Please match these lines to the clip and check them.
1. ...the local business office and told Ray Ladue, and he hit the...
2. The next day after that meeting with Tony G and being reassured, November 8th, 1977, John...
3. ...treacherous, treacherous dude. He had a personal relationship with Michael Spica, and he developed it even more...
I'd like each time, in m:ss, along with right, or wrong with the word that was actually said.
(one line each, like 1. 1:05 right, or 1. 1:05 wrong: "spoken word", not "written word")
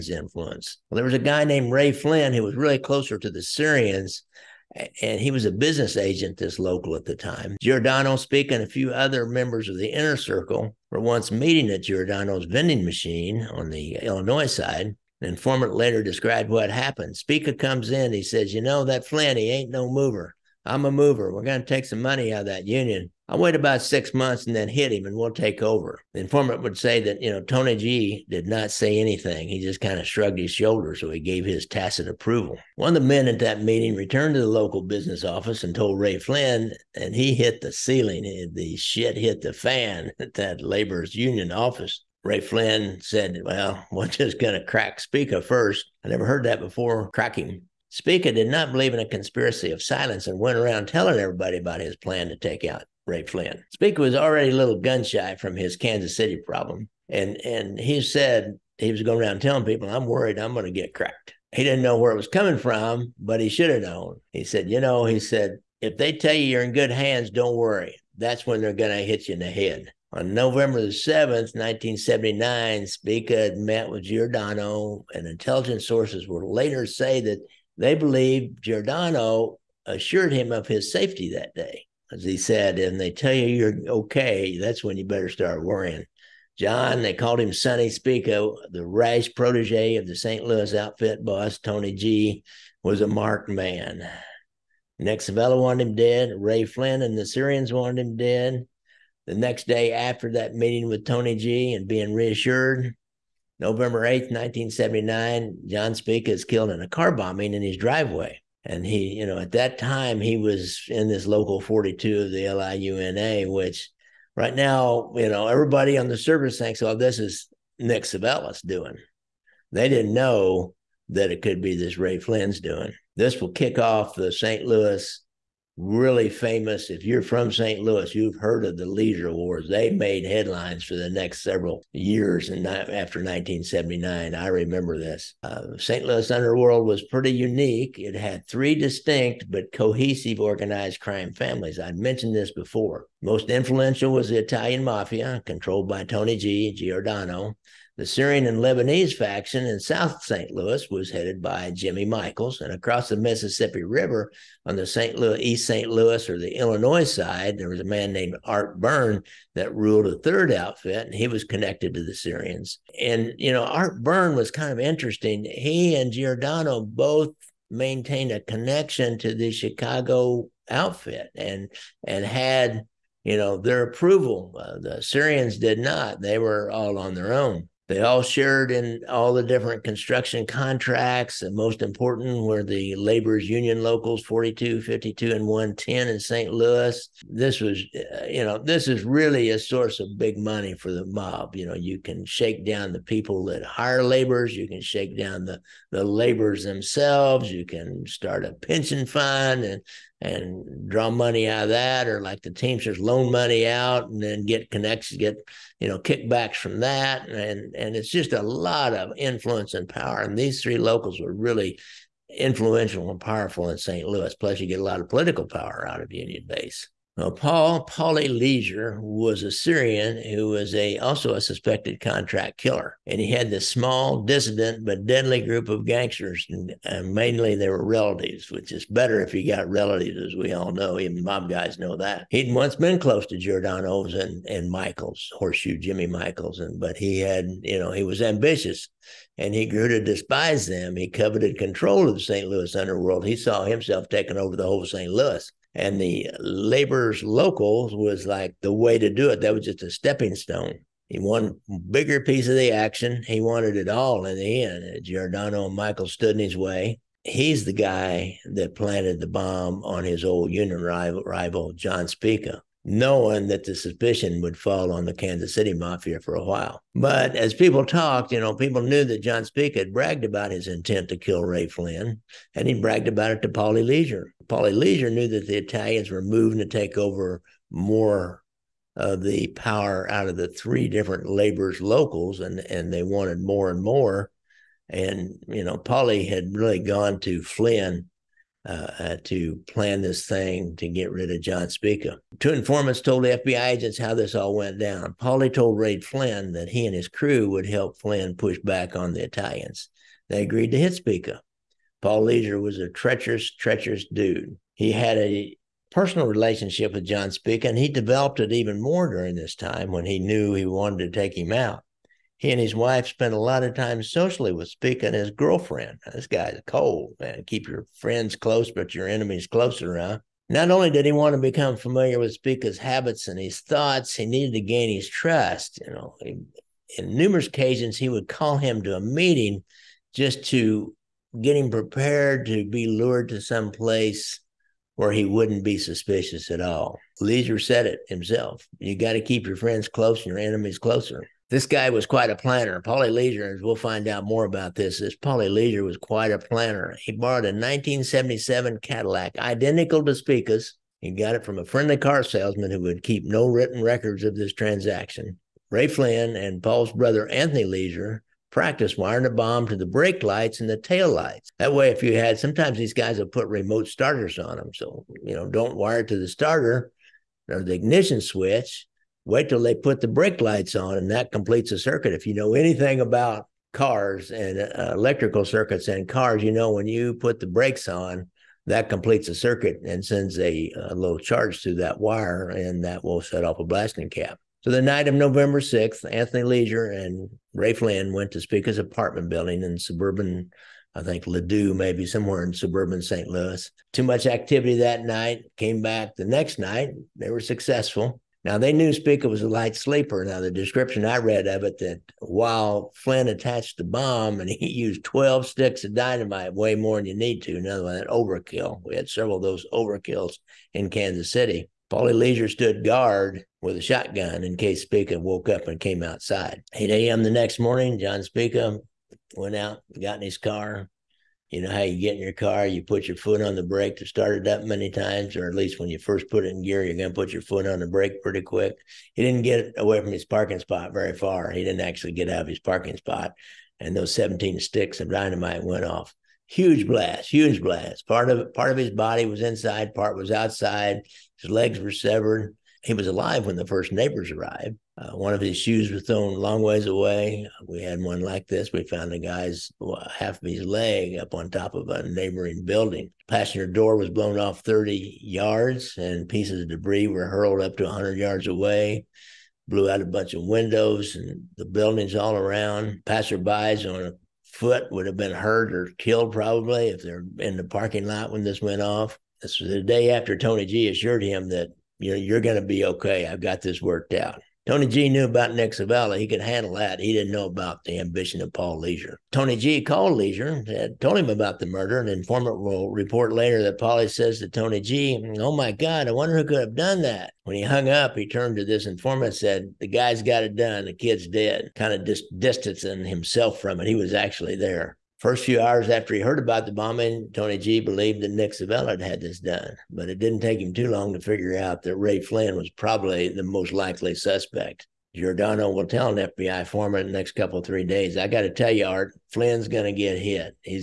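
1. 0:34 wrong: "Flynn", not "Ladue"
2. 1:39 wrong: "1979", not "1977"
3. 5:02 wrong: "John", not "Michael".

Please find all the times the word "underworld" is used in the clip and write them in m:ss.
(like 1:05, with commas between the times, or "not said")
2:16, 4:02.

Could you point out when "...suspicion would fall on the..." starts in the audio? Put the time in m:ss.
4:23.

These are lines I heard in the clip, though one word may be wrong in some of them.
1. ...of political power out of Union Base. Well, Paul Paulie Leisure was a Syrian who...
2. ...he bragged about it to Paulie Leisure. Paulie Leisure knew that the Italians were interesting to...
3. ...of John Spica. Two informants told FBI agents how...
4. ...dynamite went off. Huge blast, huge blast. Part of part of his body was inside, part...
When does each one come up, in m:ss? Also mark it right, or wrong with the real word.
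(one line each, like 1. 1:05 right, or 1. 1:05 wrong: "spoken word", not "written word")
1. 3:35 right
2. 4:32 wrong: "moving", not "interesting"
3. 4:51 right
4. 7:15 right.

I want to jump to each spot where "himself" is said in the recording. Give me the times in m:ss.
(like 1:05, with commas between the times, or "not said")
4:03, 5:38, 8:13.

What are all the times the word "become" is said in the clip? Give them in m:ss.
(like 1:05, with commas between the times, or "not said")
5:21.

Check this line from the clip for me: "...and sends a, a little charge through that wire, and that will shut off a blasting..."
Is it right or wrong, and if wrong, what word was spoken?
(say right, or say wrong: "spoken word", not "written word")
right.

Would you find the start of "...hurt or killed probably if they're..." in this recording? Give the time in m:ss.
7:45.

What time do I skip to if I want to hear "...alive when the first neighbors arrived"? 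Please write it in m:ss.
7:23.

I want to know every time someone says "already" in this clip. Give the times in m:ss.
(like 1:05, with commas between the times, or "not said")
0:54.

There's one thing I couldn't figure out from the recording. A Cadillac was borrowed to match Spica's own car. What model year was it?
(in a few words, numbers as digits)
1977.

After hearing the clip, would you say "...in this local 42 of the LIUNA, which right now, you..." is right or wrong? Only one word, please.
right.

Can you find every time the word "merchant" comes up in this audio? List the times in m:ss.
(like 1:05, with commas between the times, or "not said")
not said.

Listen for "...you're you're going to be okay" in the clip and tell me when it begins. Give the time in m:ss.
7:51.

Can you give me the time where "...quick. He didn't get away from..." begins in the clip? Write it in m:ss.
7:08.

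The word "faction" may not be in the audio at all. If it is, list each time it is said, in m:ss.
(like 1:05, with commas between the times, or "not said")
2:29.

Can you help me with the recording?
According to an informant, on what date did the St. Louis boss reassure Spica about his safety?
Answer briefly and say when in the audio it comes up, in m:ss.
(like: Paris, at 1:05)
November 7, 1979, at 1:10.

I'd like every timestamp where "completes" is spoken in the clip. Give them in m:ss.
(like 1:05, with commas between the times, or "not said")
6:11, 6:18.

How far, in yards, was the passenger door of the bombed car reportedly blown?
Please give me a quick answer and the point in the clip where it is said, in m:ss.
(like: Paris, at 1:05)
30 yards, at 7:34.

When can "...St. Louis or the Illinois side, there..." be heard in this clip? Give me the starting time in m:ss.
2:35.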